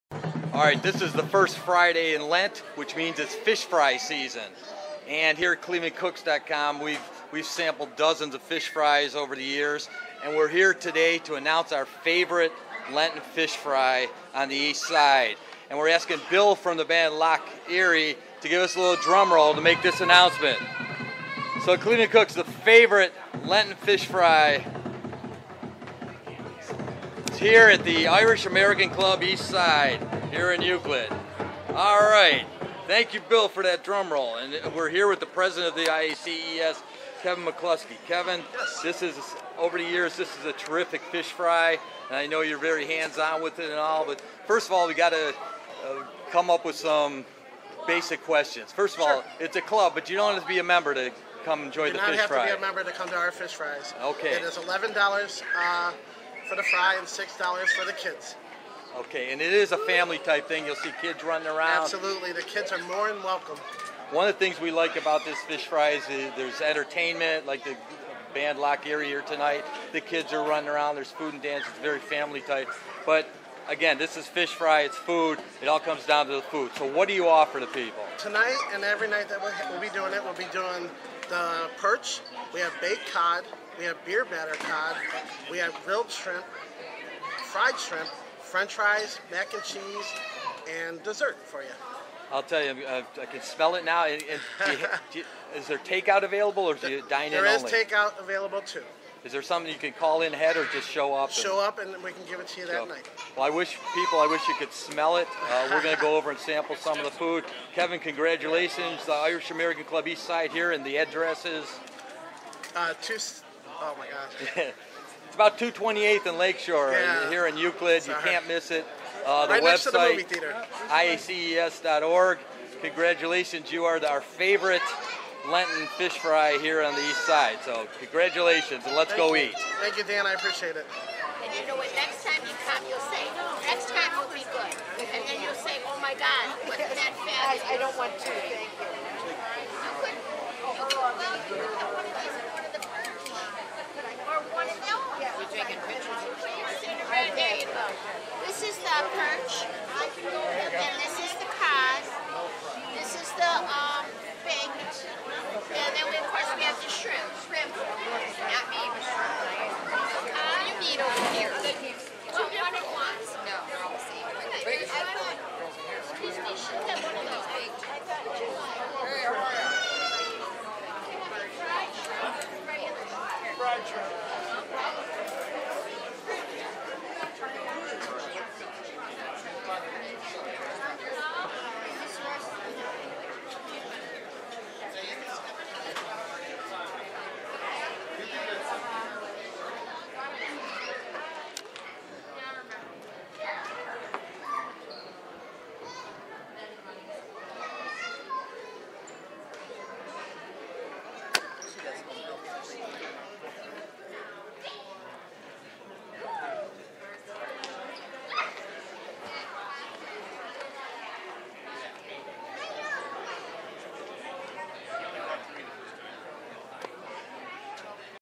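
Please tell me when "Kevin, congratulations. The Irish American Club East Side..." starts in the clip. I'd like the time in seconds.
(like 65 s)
107 s.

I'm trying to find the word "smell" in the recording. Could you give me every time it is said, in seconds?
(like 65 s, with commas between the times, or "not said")
93 s, 104 s.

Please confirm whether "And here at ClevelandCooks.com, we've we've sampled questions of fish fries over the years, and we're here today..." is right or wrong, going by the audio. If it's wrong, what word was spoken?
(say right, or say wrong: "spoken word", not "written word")
wrong: "dozens", not "questions".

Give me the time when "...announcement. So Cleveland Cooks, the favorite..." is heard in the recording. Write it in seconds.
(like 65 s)
20 s.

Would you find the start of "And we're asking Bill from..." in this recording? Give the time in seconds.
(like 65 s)
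15 s.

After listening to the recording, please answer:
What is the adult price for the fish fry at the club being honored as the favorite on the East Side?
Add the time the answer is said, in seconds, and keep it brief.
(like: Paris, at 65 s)
$11, at 54 s.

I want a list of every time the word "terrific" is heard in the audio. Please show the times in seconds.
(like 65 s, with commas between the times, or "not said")
40 s.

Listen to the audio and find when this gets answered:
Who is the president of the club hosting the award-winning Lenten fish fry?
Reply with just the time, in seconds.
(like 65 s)
37 s.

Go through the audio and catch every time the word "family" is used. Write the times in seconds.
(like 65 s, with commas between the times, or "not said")
59 s, 71 s.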